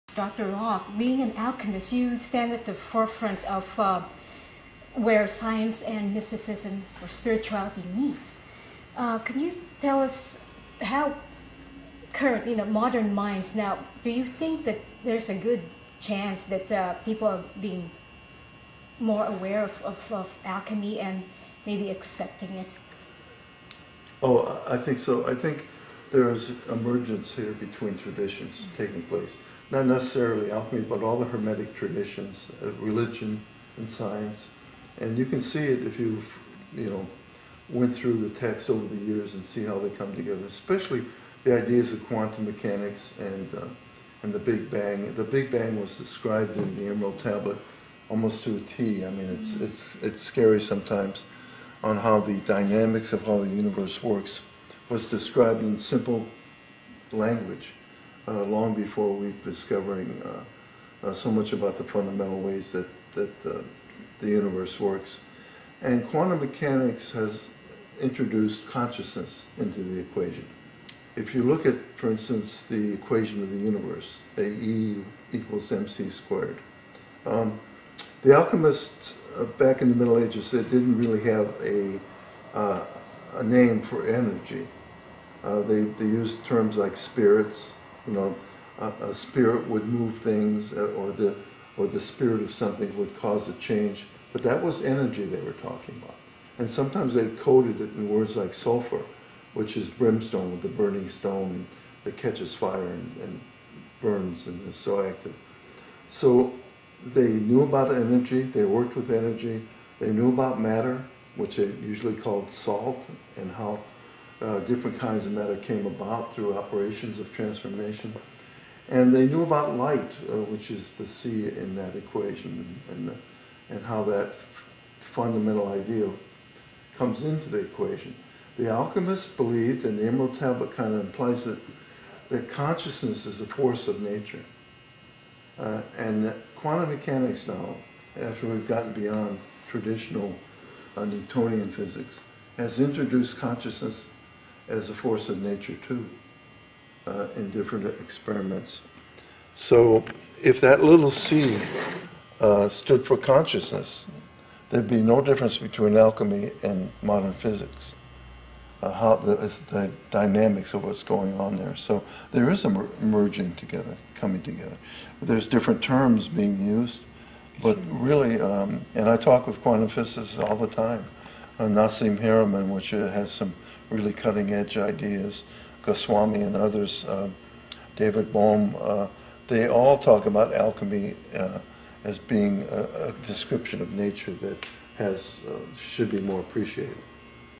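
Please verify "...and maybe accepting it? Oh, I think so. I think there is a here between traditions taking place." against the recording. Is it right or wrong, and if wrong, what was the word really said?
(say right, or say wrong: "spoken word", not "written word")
right.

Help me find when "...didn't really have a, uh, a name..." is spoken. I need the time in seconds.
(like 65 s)
80 s.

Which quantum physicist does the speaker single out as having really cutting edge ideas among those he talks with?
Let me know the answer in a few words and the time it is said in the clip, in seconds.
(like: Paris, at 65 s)
Nassim Haramein, at 171 s.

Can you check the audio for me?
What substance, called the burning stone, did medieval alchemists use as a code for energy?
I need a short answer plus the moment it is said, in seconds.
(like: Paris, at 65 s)
sulfur, at 98 s.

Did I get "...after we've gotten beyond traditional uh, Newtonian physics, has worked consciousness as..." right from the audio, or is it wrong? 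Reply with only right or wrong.
wrong.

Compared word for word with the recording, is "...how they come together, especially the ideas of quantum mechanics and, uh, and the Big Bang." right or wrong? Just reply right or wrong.
right.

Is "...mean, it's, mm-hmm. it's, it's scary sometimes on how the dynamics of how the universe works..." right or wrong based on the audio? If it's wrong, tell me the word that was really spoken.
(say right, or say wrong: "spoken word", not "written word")
right.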